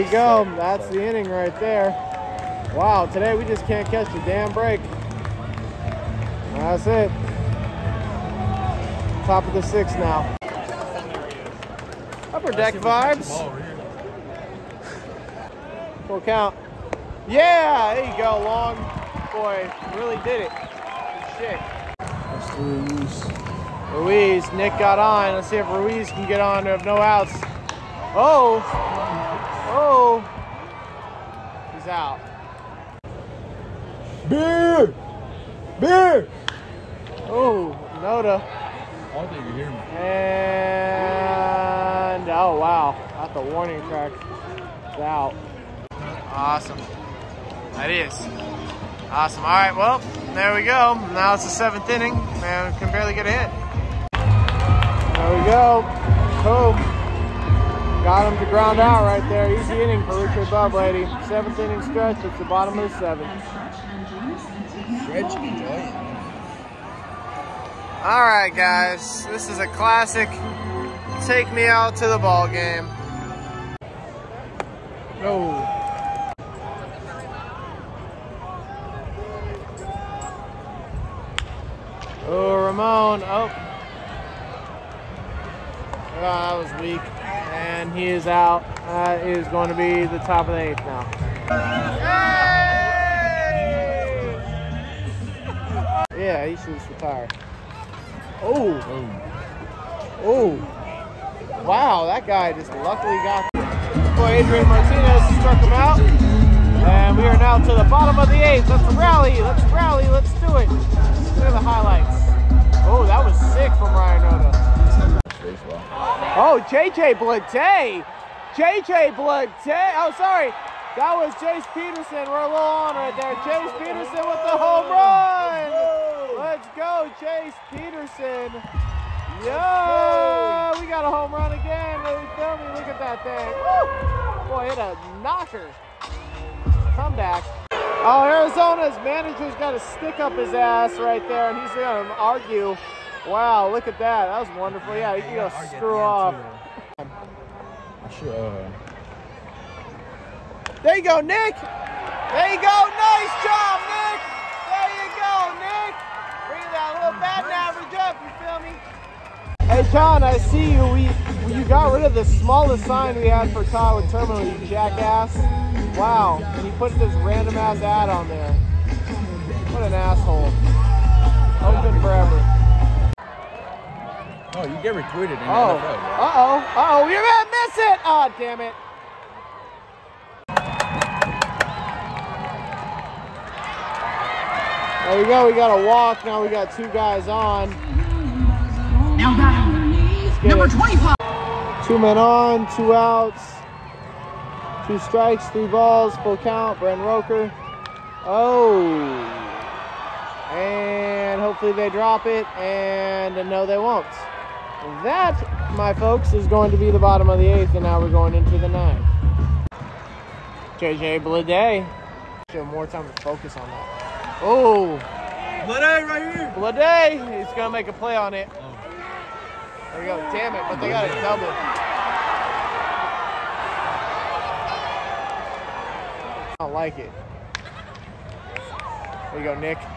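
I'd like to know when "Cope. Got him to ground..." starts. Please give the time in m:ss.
0:56.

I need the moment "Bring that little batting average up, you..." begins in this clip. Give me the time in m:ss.
2:36.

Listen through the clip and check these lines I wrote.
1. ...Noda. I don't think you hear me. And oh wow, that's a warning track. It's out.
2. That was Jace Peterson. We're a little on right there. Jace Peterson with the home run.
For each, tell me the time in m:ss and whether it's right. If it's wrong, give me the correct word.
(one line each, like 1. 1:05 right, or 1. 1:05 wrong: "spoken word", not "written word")
1. 0:38 right
2. 2:00 right.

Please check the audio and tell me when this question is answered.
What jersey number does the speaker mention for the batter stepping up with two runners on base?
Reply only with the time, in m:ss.
3:10.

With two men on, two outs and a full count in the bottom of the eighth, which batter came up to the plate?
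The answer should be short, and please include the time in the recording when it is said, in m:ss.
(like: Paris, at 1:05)
Brent Rooker, at 3:16.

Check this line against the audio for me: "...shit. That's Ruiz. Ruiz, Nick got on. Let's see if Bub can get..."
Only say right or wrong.
wrong.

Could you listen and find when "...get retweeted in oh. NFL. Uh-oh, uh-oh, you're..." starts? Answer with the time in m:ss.
2:54.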